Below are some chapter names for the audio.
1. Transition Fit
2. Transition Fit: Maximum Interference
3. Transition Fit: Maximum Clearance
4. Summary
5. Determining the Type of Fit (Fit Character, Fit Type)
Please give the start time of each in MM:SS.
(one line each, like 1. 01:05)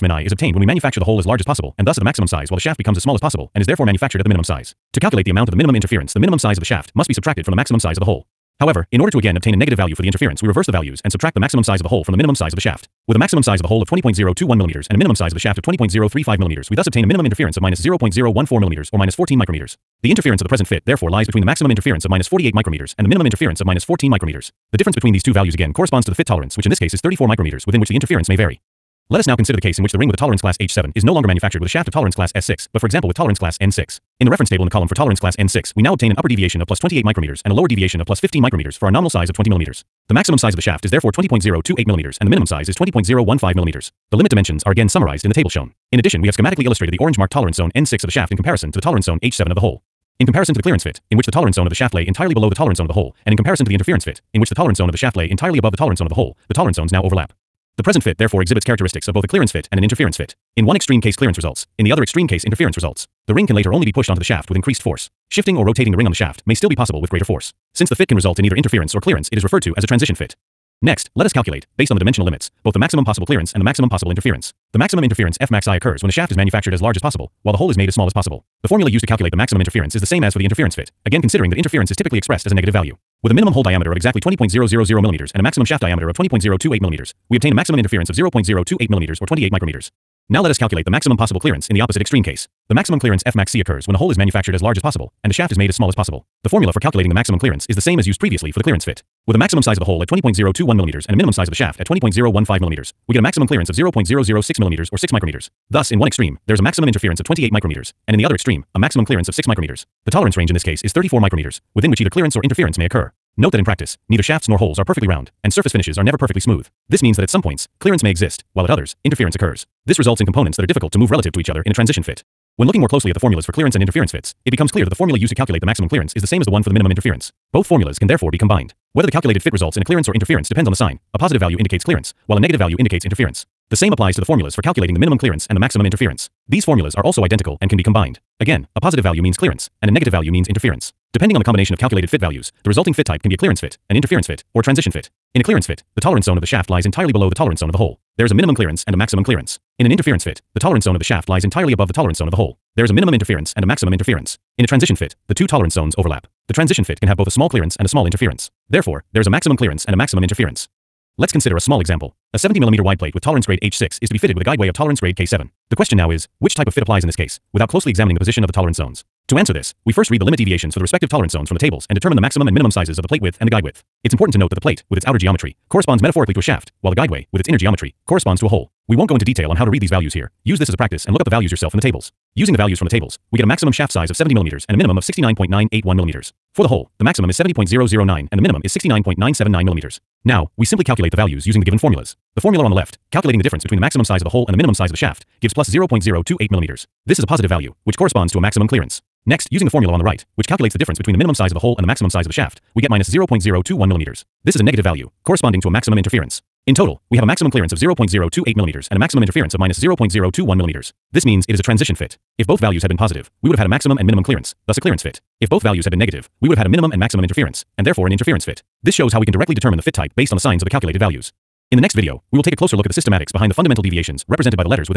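1. 00:28
2. 01:10
3. 01:30
4. 02:02
5. 02:40.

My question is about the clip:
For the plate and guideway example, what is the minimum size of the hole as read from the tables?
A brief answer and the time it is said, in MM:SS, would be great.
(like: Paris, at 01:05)
69.979 mm, at 03:08.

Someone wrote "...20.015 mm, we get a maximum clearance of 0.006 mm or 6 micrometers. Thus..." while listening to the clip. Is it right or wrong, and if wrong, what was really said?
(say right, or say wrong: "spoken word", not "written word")
right.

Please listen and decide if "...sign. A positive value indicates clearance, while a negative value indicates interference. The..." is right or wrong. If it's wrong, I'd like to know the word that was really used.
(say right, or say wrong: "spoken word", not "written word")
right.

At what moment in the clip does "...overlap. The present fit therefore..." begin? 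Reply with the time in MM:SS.
00:57.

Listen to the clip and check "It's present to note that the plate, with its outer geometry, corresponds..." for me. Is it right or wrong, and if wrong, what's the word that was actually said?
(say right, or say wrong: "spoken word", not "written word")
wrong: "important", not "present".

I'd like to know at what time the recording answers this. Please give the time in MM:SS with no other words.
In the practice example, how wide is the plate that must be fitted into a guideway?
02:42.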